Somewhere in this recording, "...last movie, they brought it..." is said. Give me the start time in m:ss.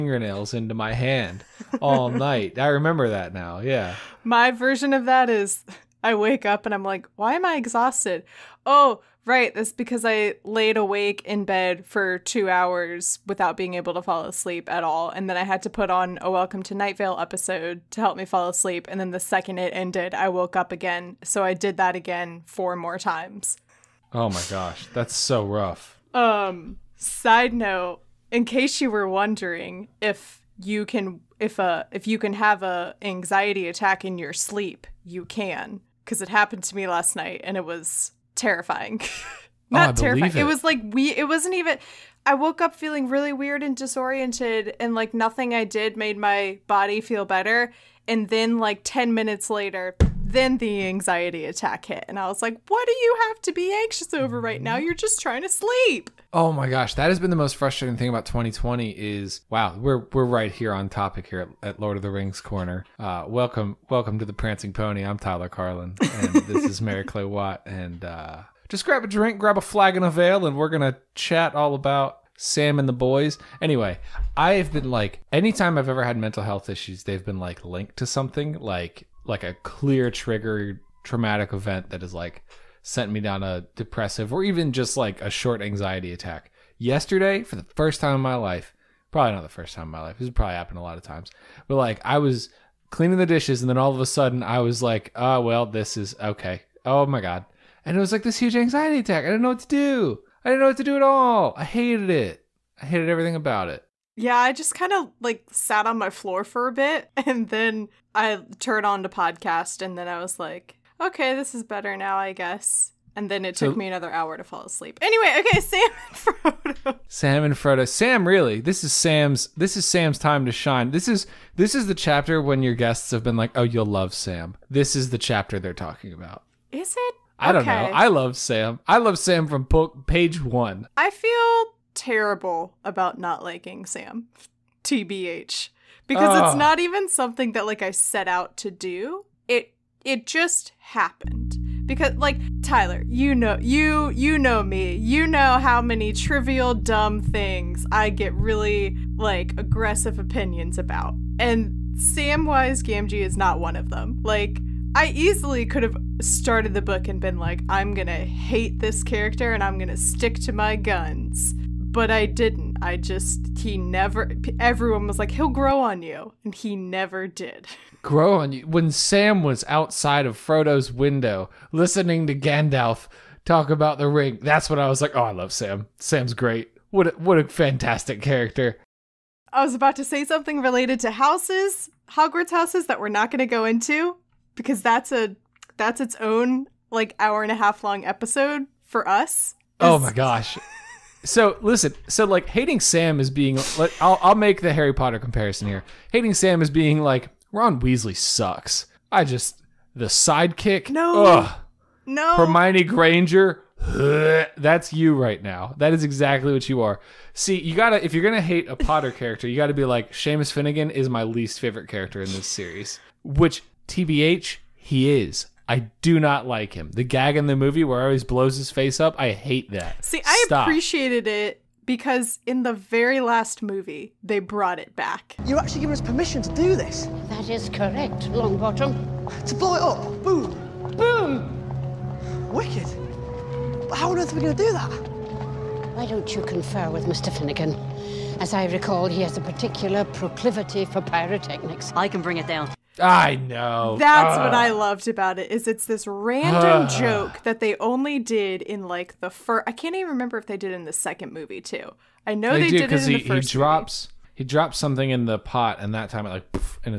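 3:43.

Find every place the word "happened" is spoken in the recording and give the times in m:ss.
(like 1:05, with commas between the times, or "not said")
0:36, 1:30, 2:20.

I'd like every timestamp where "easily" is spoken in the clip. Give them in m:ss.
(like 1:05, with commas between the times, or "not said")
2:35.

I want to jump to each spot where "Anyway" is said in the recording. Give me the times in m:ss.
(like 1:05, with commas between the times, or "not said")
1:13, 1:55.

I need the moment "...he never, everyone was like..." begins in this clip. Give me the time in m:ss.
2:43.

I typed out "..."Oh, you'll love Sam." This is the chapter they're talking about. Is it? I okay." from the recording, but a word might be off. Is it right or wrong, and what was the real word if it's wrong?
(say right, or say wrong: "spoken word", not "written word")
right.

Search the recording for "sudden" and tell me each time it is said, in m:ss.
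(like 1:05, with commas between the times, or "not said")
1:34.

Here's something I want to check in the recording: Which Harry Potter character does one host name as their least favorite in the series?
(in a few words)
Seamus Finnigan.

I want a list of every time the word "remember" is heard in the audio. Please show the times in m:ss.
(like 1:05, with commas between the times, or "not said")
0:02, 4:10.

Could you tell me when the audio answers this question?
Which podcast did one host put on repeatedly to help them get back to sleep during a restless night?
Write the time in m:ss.
0:16.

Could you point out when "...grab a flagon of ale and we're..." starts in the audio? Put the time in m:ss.
1:09.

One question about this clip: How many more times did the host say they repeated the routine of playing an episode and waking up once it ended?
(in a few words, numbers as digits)
4.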